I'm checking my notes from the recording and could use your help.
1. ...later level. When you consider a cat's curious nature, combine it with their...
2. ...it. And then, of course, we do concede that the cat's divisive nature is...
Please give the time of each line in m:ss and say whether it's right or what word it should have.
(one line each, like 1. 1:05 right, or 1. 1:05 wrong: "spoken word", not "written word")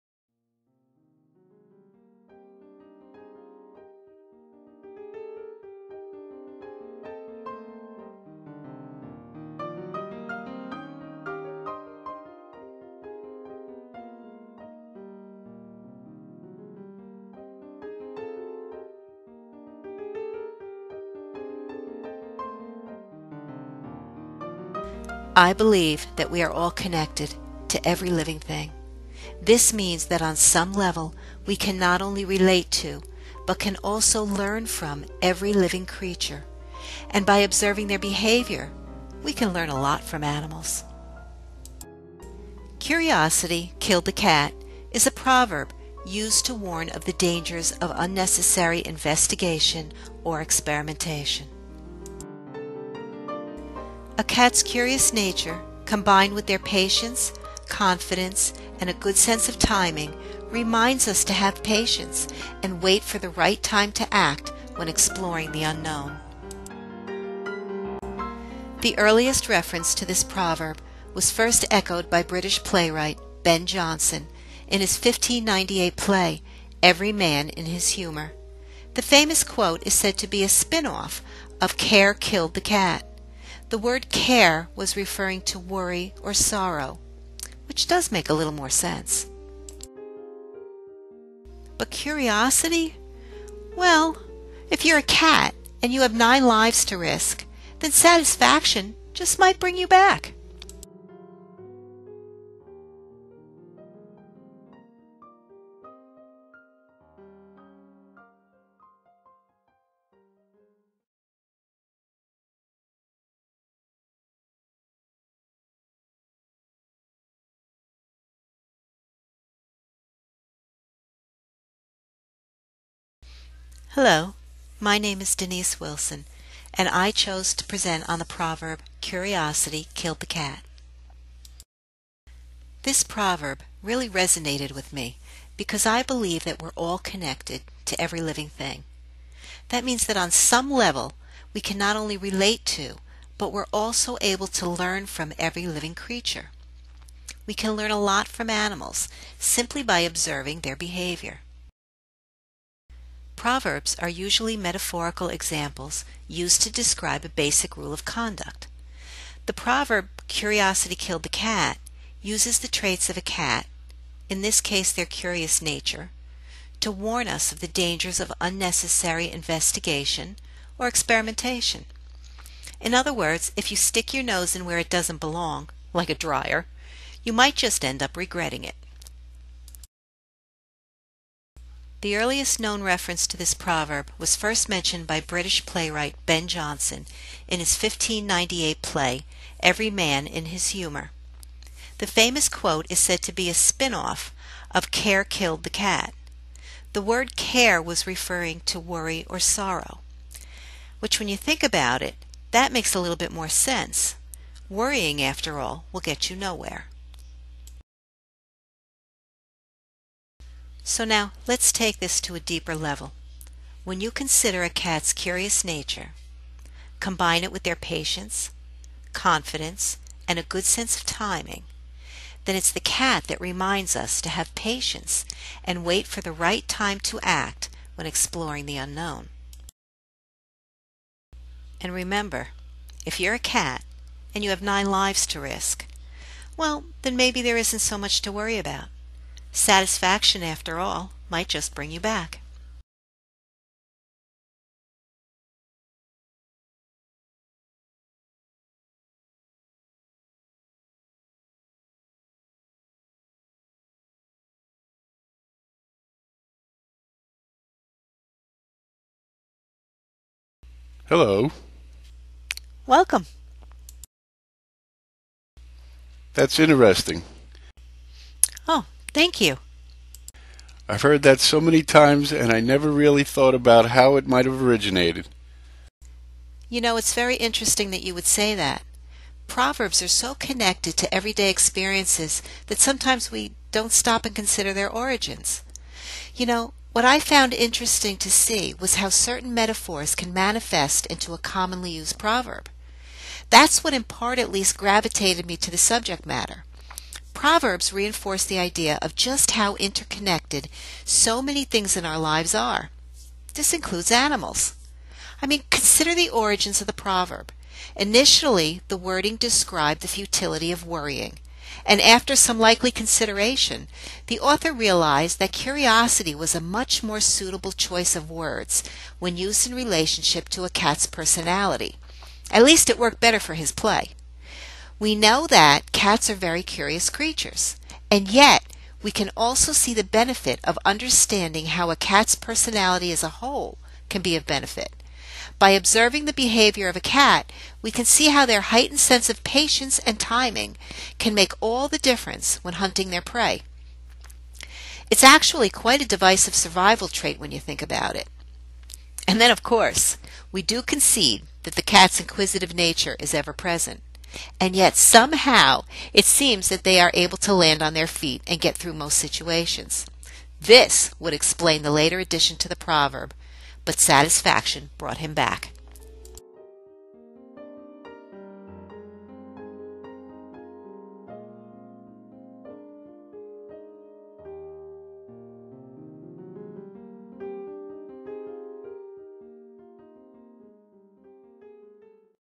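1. 3:32 wrong: "deeper", not "later"
2. 5:48 wrong: "inquisitive", not "divisive".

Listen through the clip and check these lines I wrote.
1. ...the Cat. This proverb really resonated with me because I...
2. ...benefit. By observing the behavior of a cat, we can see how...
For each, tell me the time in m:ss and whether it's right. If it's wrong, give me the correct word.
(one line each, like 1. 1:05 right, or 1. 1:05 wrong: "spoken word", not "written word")
1. 2:10 right
2. 5:34 right.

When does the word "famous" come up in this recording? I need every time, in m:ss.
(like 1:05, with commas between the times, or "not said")
1:19, 3:12.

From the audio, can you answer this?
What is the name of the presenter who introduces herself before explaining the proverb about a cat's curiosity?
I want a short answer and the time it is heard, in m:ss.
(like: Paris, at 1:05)
Denise Wilson, at 2:05.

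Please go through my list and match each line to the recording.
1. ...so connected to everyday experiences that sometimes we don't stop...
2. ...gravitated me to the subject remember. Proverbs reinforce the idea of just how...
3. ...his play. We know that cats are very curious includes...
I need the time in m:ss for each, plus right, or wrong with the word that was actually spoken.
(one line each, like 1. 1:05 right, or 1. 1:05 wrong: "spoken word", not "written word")
1. 4:40 right
2. 4:54 wrong: "matter", not "remember"
3. 5:23 wrong: "creatures", not "includes".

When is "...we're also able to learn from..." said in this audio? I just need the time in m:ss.
2:23.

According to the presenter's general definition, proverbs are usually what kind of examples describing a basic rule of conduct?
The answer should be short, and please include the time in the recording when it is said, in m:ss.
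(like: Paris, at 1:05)
Metaphorical examples, at 2:34.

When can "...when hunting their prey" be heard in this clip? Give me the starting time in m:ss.
5:42.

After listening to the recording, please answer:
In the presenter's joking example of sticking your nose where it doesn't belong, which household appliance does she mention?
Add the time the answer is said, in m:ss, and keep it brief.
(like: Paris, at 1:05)
A dryer, at 2:56.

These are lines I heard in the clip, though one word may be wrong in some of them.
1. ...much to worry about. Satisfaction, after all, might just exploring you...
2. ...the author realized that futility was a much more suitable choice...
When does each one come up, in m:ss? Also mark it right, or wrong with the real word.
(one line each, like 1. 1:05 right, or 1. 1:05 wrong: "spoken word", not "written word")
1. 3:57 wrong: "bring", not "exploring"
2. 5:14 wrong: "curiosity", not "futility".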